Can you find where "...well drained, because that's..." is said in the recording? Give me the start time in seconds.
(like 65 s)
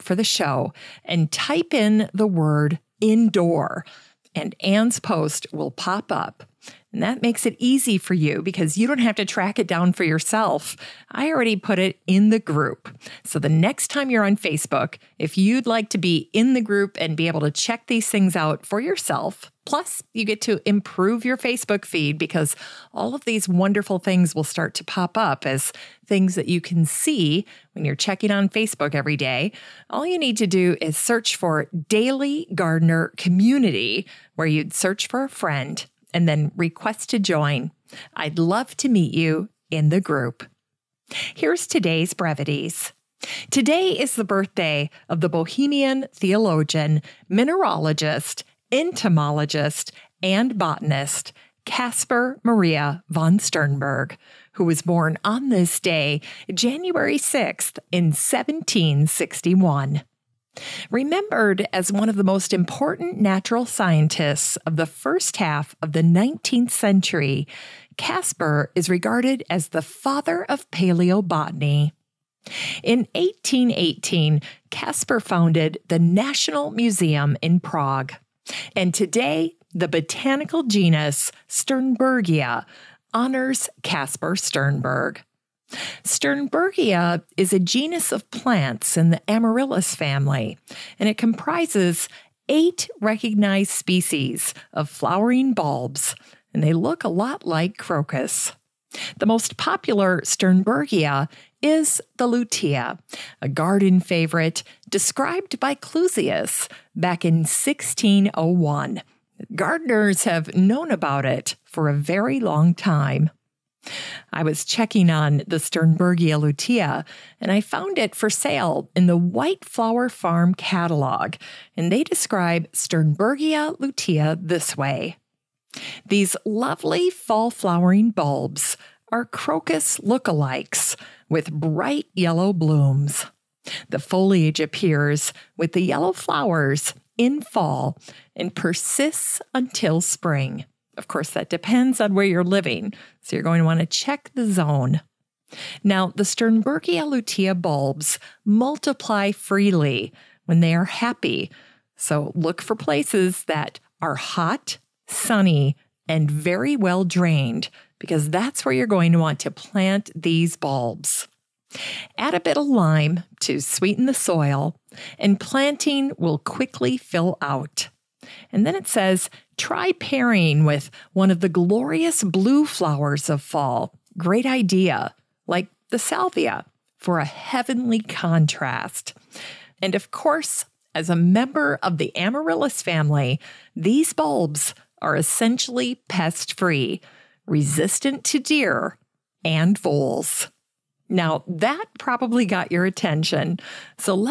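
156 s.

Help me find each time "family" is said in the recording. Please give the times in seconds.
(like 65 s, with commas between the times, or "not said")
89 s, 182 s.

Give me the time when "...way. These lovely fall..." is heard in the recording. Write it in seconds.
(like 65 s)
124 s.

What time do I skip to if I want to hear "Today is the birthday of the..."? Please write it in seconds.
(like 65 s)
43 s.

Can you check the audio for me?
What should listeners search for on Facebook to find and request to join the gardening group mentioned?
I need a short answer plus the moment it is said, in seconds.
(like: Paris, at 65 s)
Daily Gardener Community, at 31 s.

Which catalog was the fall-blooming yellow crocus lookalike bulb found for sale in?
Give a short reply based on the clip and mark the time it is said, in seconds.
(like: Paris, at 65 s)
White Flower Farm, at 119 s.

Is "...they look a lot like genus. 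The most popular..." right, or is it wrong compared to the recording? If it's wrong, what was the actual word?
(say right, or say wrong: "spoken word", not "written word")
wrong: "crocus", not "genus".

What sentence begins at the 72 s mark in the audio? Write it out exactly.
In 1818, Kaspar founded the National Museum in Prague.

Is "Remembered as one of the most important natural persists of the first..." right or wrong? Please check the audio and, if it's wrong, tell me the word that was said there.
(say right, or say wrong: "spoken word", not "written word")
wrong: "scientists", not "persists".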